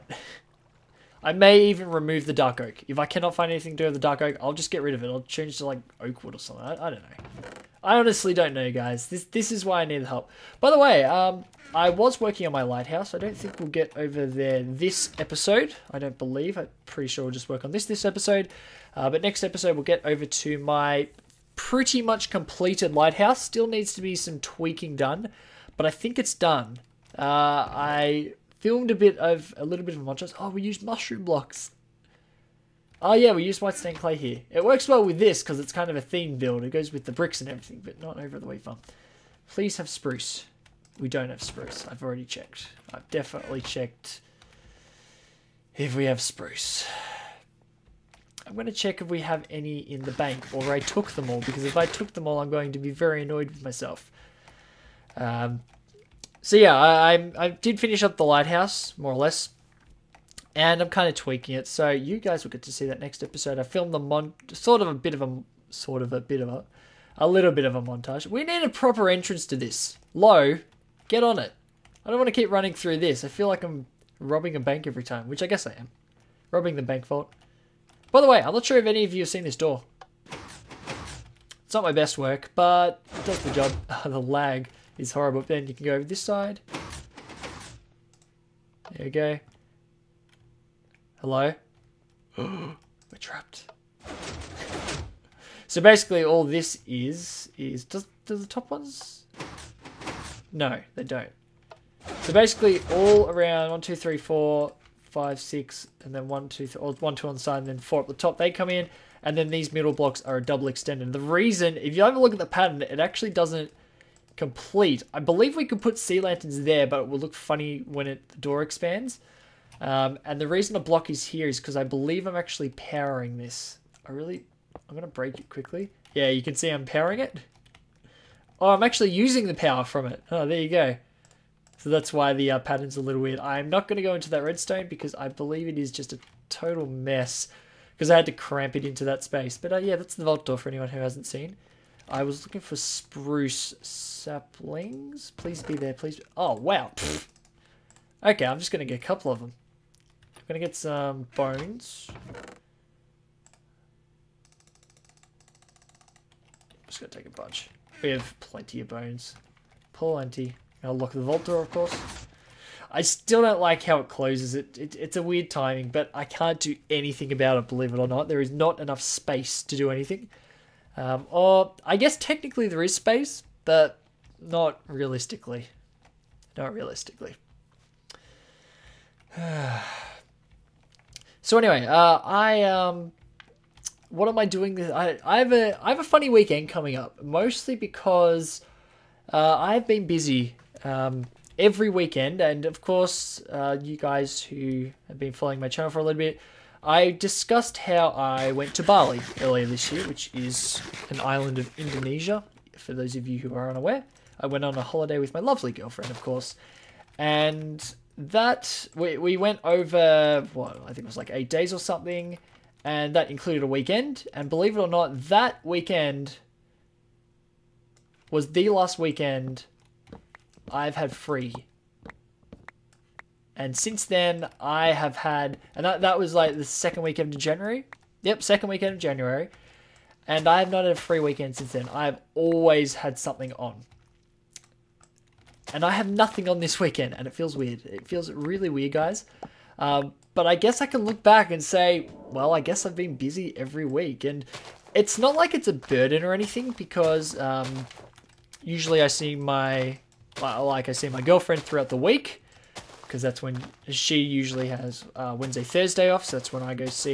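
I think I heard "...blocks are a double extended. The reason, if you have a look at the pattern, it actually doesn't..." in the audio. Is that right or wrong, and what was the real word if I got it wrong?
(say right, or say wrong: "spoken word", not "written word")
right.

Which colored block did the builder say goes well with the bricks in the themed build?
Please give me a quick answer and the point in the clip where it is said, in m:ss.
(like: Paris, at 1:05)
white stained clay, at 0:33.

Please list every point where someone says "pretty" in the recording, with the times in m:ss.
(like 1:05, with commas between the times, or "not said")
0:16, 0:21.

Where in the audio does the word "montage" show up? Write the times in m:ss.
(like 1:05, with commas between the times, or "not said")
0:30, 1:07.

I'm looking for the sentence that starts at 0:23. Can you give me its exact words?
Still needs to be some tweaking done, but I think it's done.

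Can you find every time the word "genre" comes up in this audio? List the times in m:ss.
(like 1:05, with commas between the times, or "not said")
not said.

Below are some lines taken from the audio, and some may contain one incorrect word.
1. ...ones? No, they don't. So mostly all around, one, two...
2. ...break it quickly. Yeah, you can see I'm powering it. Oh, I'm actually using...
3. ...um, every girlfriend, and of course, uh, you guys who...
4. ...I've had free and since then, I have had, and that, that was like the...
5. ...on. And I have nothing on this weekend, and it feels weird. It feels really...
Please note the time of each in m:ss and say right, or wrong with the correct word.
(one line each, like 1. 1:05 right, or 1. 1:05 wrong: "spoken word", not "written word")
1. 1:38 wrong: "basically", not "mostly"
2. 2:05 right
3. 3:10 wrong: "weekend", not "girlfriend"
4. 3:40 right
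5. 3:53 right.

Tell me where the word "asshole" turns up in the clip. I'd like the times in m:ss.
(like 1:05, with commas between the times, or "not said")
not said.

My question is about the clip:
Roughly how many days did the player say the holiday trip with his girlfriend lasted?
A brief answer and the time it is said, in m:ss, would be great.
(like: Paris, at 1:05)
8, at 3:31.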